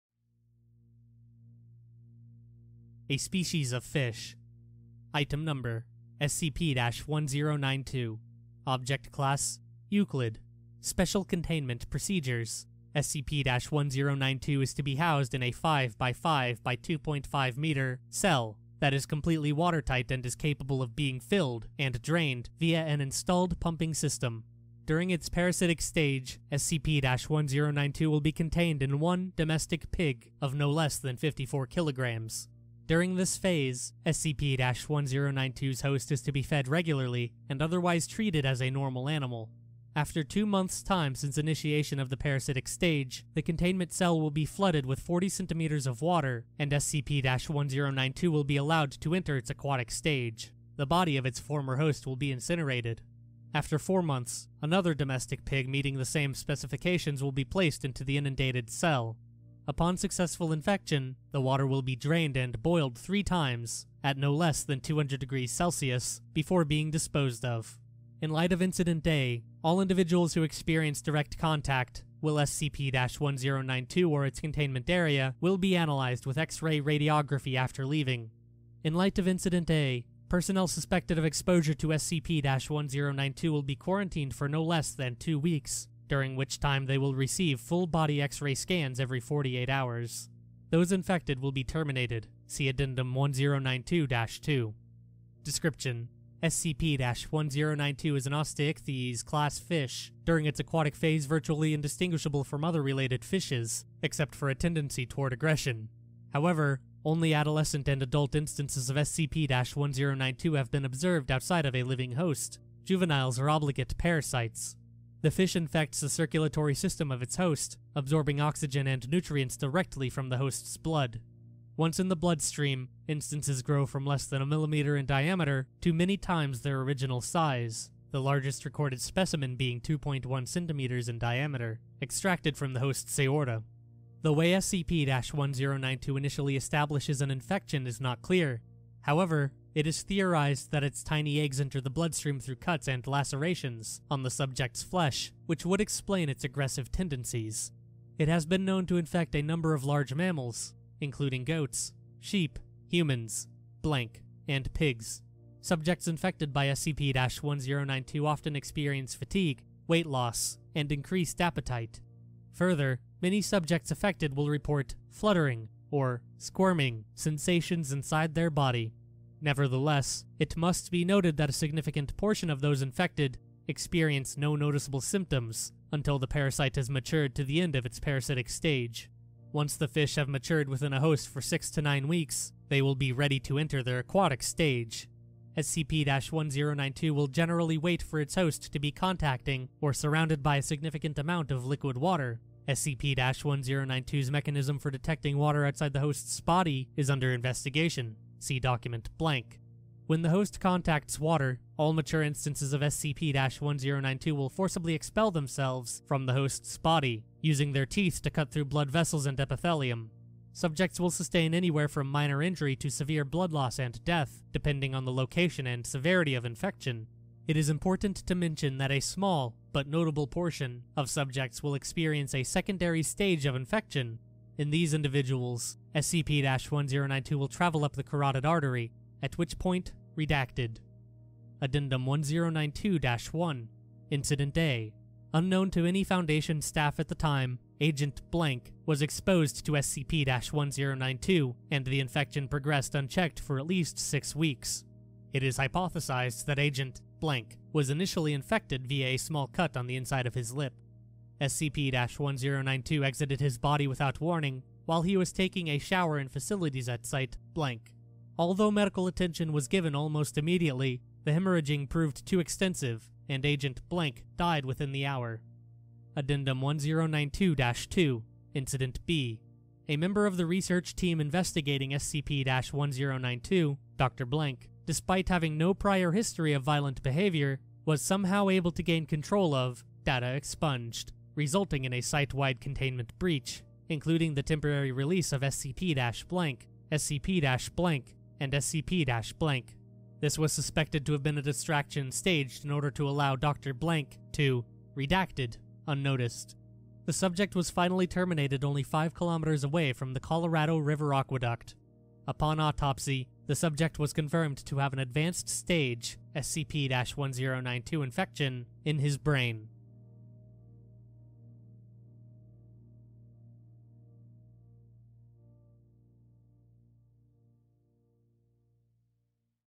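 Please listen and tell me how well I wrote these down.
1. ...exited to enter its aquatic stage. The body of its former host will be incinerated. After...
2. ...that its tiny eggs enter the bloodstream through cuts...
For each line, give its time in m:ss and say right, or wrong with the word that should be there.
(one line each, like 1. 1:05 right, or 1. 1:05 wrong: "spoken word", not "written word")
1. 0:48 wrong: "allowed", not "exited"
2. 2:20 right.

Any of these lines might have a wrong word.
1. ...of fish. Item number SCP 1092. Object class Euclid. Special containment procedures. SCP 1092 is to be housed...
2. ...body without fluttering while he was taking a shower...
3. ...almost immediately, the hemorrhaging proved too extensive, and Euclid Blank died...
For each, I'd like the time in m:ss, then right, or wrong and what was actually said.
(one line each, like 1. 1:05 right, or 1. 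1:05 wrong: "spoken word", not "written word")
1. 0:03 right
2. 4:13 wrong: "warning", not "fluttering"
3. 4:19 wrong: "Agent", not "Euclid".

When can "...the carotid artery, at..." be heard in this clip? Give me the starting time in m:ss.
3:47.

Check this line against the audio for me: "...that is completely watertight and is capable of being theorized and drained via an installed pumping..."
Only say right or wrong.
wrong.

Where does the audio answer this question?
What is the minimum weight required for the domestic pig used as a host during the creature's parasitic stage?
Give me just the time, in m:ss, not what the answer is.
0:31.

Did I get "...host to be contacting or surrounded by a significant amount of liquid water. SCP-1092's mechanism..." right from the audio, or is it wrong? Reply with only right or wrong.
right.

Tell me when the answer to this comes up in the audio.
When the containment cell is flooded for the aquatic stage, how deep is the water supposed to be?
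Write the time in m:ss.
0:44.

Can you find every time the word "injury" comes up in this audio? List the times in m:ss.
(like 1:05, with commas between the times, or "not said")
3:32.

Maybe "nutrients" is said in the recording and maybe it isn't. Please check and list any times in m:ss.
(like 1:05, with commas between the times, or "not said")
1:59.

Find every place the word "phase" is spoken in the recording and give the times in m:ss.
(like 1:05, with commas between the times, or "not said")
0:33, 1:40.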